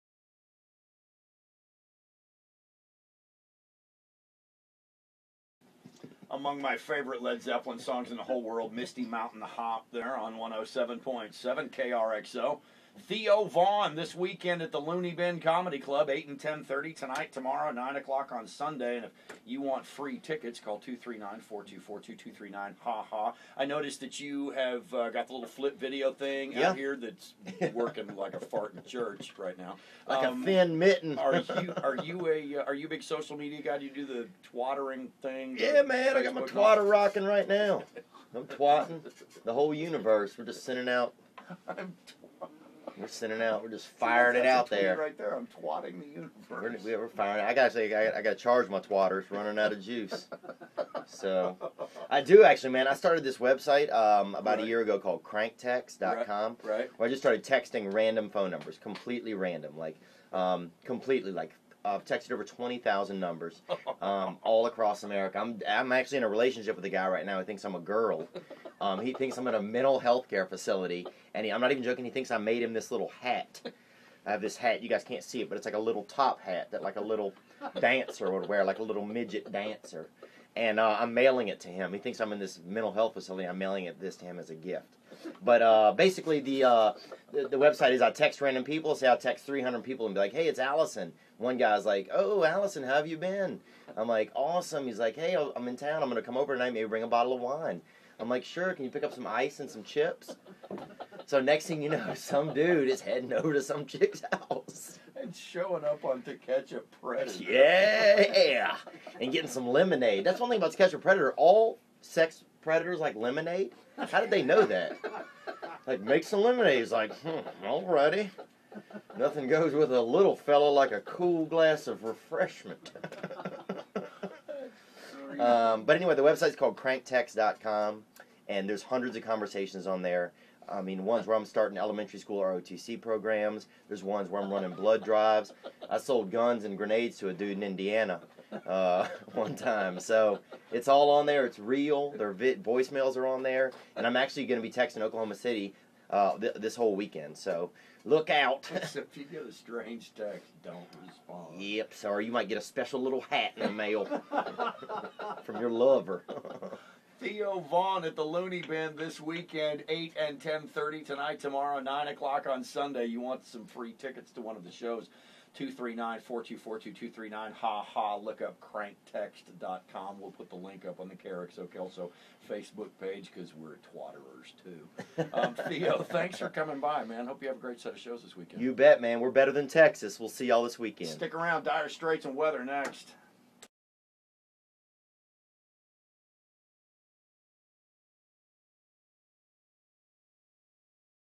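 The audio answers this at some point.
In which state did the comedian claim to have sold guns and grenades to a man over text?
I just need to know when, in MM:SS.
02:17.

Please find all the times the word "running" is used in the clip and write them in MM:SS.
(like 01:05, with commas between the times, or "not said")
00:49, 02:14.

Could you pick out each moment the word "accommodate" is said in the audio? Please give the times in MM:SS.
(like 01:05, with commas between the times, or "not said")
not said.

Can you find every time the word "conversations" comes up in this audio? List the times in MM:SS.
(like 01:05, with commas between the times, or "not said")
02:09.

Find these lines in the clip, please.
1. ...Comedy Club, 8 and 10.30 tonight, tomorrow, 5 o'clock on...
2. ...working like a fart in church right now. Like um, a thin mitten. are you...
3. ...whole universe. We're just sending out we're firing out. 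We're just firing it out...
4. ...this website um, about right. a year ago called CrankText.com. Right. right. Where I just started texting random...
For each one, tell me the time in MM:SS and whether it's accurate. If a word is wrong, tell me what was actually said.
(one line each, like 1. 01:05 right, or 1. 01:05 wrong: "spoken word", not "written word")
1. 00:15 wrong: "9", not "5"
2. 00:27 right
3. 00:39 wrong: "sending", not "firing"
4. 00:53 right.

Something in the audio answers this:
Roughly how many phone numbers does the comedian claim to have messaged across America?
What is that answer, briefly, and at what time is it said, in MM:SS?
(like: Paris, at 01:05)
20,000, at 01:02.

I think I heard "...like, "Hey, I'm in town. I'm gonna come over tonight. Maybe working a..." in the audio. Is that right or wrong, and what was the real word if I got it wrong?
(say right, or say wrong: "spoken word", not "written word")
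wrong: "bring", not "working".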